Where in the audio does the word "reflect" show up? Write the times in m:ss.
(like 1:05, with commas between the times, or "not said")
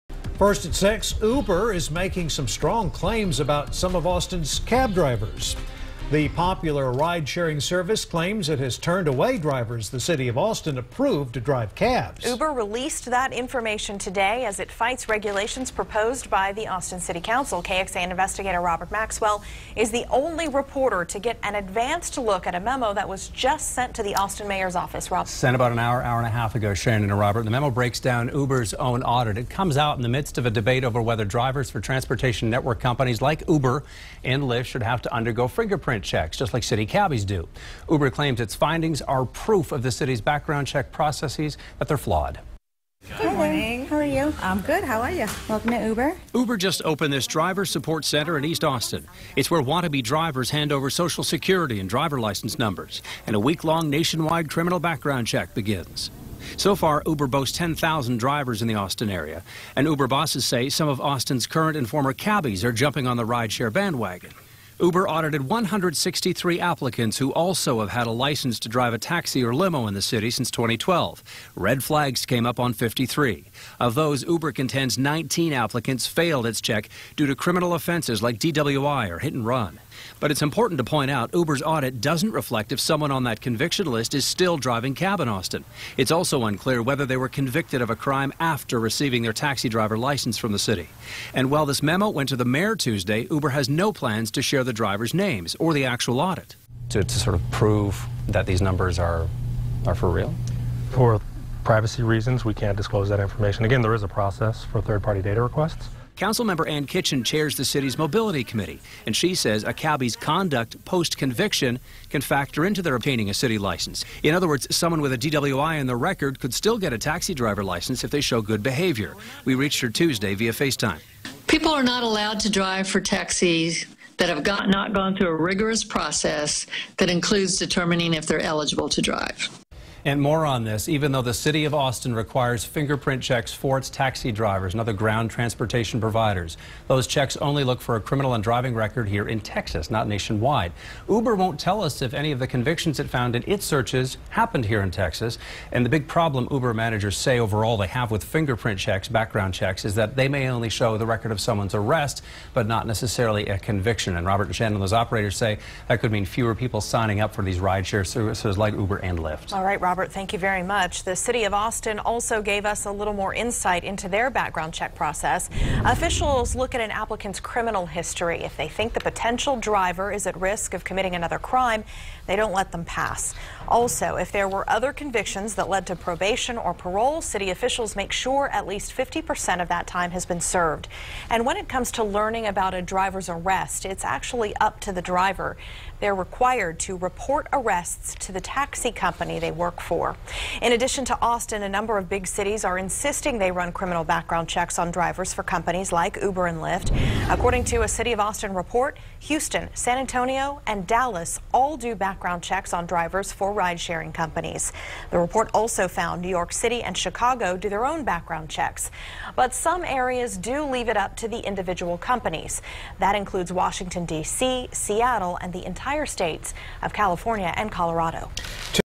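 1:22.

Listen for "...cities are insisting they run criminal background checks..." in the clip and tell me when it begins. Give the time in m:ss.
3:12.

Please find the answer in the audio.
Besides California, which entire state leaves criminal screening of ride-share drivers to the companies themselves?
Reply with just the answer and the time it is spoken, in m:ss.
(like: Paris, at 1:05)
Colorado, at 3:37.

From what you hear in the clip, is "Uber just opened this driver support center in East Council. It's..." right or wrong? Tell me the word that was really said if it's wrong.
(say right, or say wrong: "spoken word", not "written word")
wrong: "Austin", not "Council".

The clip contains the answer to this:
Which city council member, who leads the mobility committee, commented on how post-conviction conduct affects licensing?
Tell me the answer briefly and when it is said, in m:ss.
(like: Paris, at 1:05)
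Ann Kitchen, at 1:46.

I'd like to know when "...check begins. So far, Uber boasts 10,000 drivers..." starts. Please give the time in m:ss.
0:55.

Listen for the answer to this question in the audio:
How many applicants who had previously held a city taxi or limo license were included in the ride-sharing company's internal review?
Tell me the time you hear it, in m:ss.
1:05.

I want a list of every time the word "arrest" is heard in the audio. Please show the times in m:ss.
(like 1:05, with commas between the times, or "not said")
2:31, 3:03, 3:07.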